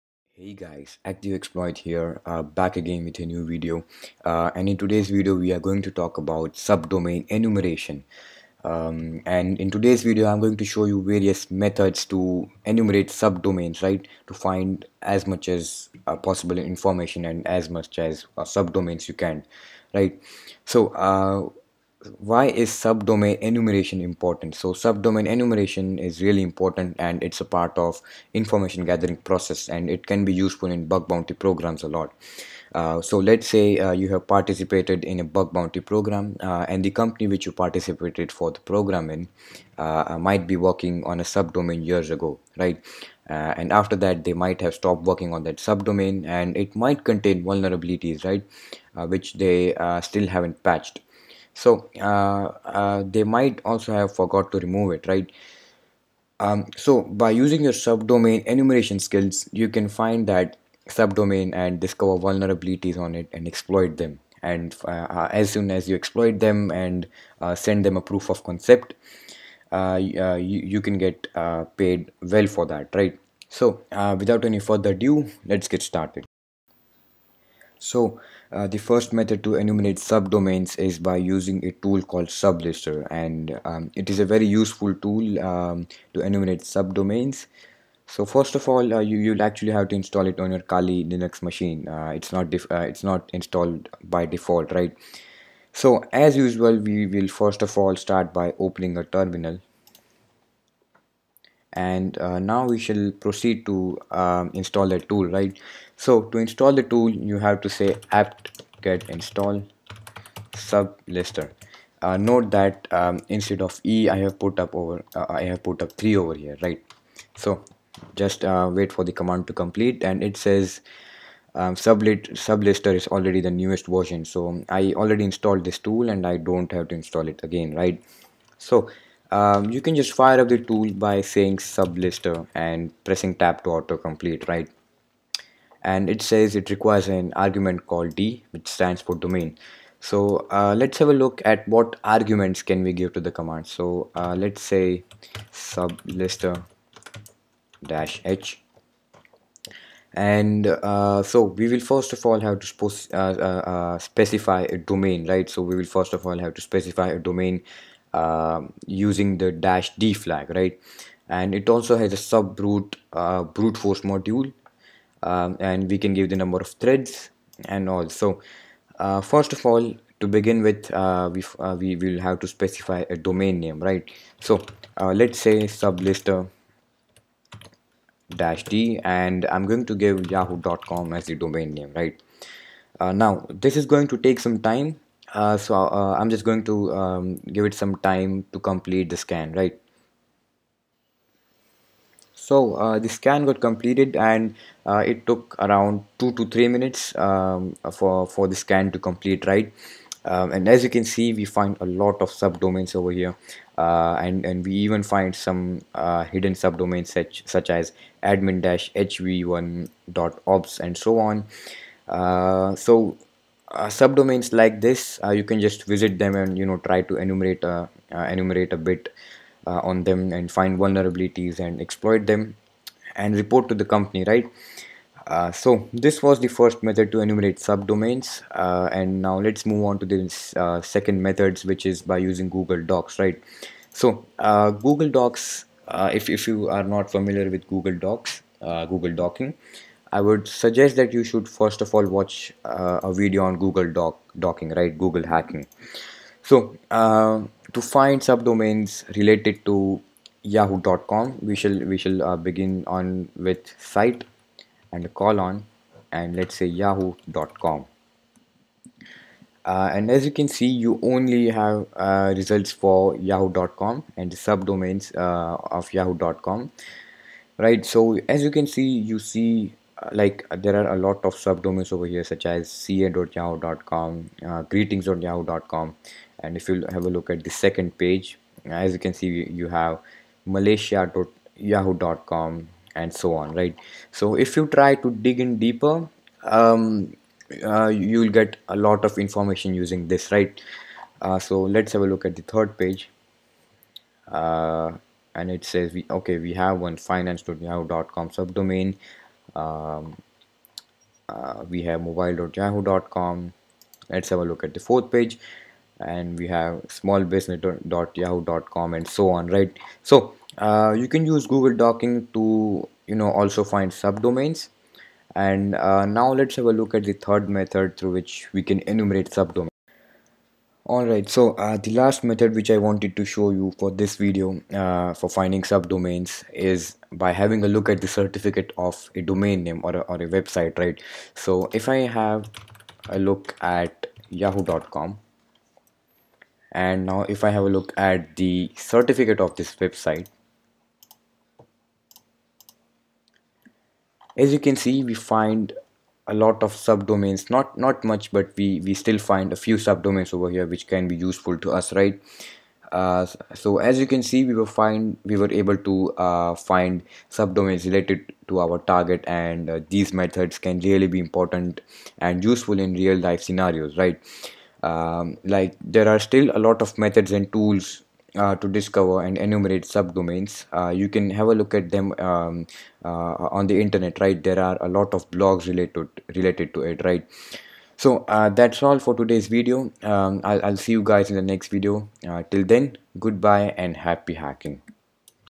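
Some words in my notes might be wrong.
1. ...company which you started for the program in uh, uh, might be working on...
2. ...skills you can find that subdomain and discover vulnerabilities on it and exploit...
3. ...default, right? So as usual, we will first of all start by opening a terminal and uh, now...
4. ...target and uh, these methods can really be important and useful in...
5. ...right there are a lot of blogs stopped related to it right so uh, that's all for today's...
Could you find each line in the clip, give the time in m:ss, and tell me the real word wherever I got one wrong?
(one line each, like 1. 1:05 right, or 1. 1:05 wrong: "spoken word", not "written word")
1. 0:36 wrong: "participated", not "started"
2. 0:58 right
3. 1:34 right
4. 5:58 right
5. 6:14 wrong: "related", not "stopped".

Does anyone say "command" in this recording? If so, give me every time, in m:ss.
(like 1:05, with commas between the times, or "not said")
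1:59, 2:23.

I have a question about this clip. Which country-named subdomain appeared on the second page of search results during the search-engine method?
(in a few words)
malaysia.yahoo.com.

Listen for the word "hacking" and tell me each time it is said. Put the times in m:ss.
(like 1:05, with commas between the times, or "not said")
4:05, 6:24.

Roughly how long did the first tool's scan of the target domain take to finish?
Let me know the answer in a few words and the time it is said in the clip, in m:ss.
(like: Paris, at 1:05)
2 to 3 minutes, at 3:16.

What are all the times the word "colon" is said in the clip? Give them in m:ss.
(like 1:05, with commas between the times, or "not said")
4:15.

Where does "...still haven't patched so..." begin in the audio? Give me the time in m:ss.
0:50.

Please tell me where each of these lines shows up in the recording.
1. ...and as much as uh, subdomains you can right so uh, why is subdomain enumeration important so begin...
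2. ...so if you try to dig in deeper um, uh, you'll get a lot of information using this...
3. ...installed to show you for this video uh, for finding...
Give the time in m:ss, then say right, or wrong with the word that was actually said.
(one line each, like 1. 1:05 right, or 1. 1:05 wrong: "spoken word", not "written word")
1. 0:17 wrong: "subdomain", not "begin"
2. 4:44 right
3. 5:22 wrong: "wanted", not "installed".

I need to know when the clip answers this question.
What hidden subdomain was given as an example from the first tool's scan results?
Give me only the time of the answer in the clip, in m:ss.
3:28.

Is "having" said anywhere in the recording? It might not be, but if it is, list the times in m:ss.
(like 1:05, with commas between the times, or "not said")
5:27.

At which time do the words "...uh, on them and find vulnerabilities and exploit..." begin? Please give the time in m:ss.
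3:39.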